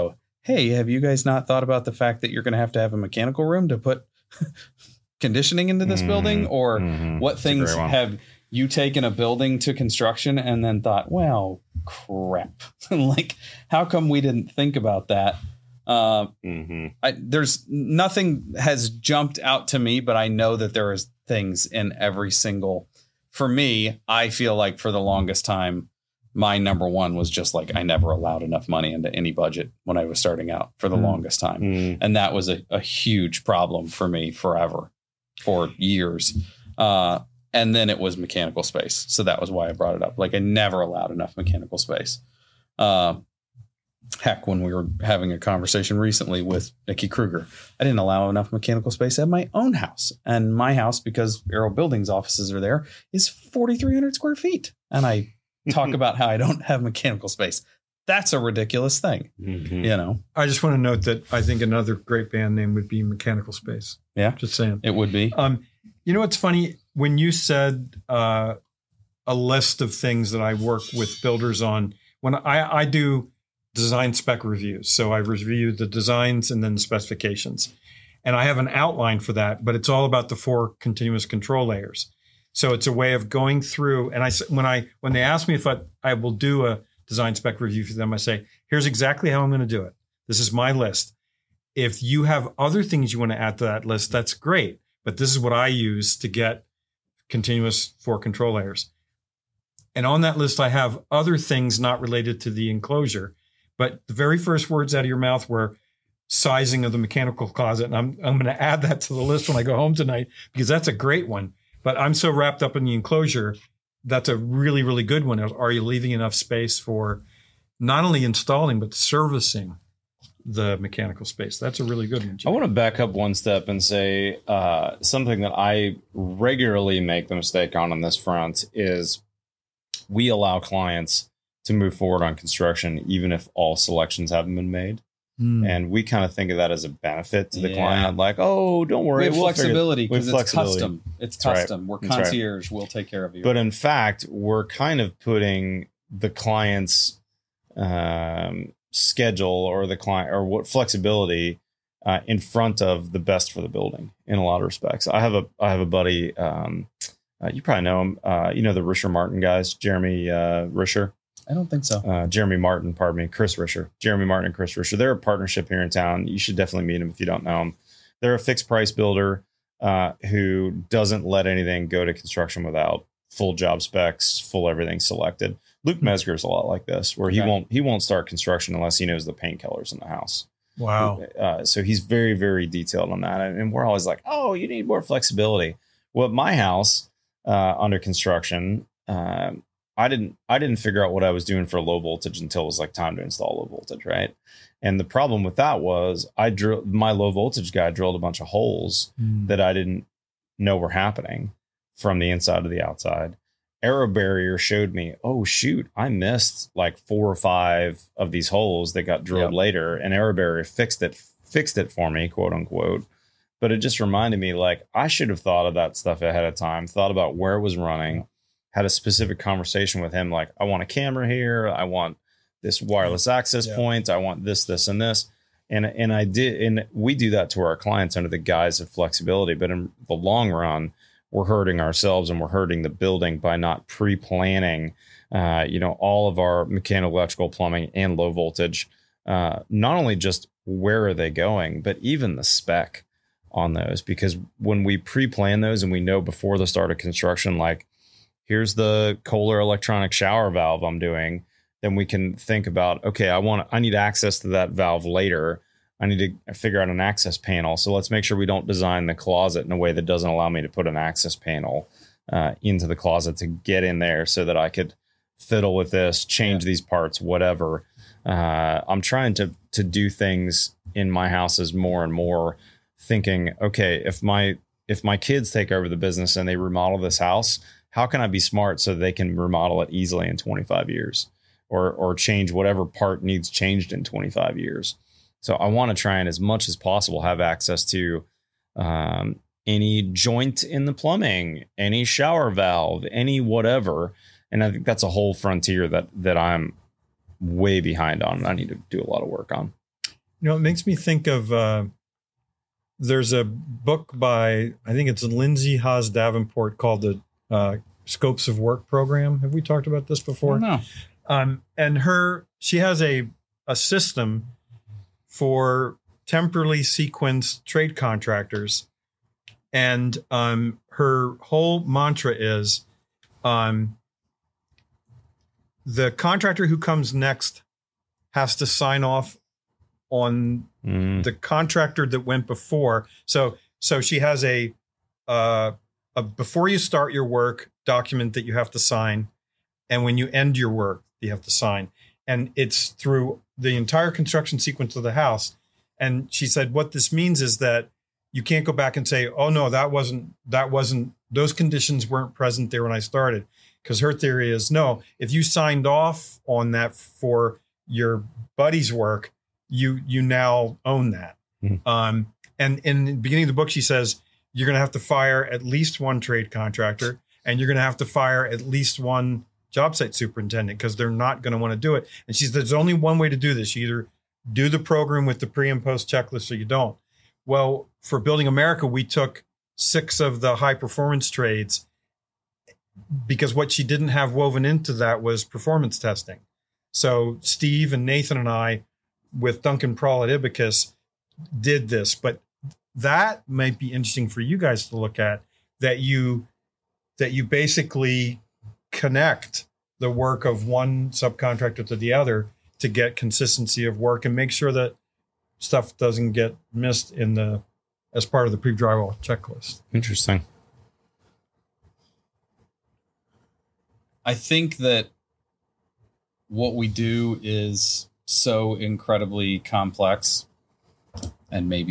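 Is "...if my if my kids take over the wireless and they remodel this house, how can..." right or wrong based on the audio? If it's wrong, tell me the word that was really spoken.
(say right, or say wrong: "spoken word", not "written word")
wrong: "business", not "wireless".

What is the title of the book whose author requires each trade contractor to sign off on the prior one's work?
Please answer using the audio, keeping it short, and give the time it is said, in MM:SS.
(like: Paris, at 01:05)
Scopes of Work program, at 05:08.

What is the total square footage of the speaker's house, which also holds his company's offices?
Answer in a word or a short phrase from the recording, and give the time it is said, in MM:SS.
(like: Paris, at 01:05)
4,300, at 00:53.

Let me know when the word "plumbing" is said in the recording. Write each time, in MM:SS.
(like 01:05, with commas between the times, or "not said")
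03:57, 04:50.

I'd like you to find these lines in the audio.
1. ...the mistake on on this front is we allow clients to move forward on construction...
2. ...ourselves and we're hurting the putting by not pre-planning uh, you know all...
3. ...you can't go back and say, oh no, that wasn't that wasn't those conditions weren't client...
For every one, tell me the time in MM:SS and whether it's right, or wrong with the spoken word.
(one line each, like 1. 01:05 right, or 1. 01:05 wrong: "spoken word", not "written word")
1. 02:07 right
2. 03:51 wrong: "building", not "putting"
3. 05:48 wrong: "present", not "client".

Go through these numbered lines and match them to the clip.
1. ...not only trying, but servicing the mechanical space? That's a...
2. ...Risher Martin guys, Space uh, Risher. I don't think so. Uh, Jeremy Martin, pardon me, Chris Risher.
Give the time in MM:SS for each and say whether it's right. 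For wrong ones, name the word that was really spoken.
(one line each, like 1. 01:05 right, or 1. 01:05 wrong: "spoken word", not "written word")
1. 01:57 wrong: "installing", not "trying"
2. 02:38 wrong: "Jeremy", not "Space".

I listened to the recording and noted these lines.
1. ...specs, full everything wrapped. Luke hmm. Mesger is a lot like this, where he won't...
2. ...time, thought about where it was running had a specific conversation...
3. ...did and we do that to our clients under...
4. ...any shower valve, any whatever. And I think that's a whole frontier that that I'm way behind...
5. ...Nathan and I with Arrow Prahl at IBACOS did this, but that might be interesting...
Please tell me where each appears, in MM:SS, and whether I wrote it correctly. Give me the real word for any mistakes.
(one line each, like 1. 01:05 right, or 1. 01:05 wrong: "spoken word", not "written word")
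1. 02:53 wrong: "selected", not "wrapped"
2. 03:36 right
3. 03:46 right
4. 04:51 right
5. 06:28 wrong: "Duncan", not "Arrow".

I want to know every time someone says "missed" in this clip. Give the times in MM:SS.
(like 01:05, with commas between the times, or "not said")
03:26, 06:46.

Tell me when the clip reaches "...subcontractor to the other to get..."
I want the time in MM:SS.
06:41.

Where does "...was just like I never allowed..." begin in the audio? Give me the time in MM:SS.
00:27.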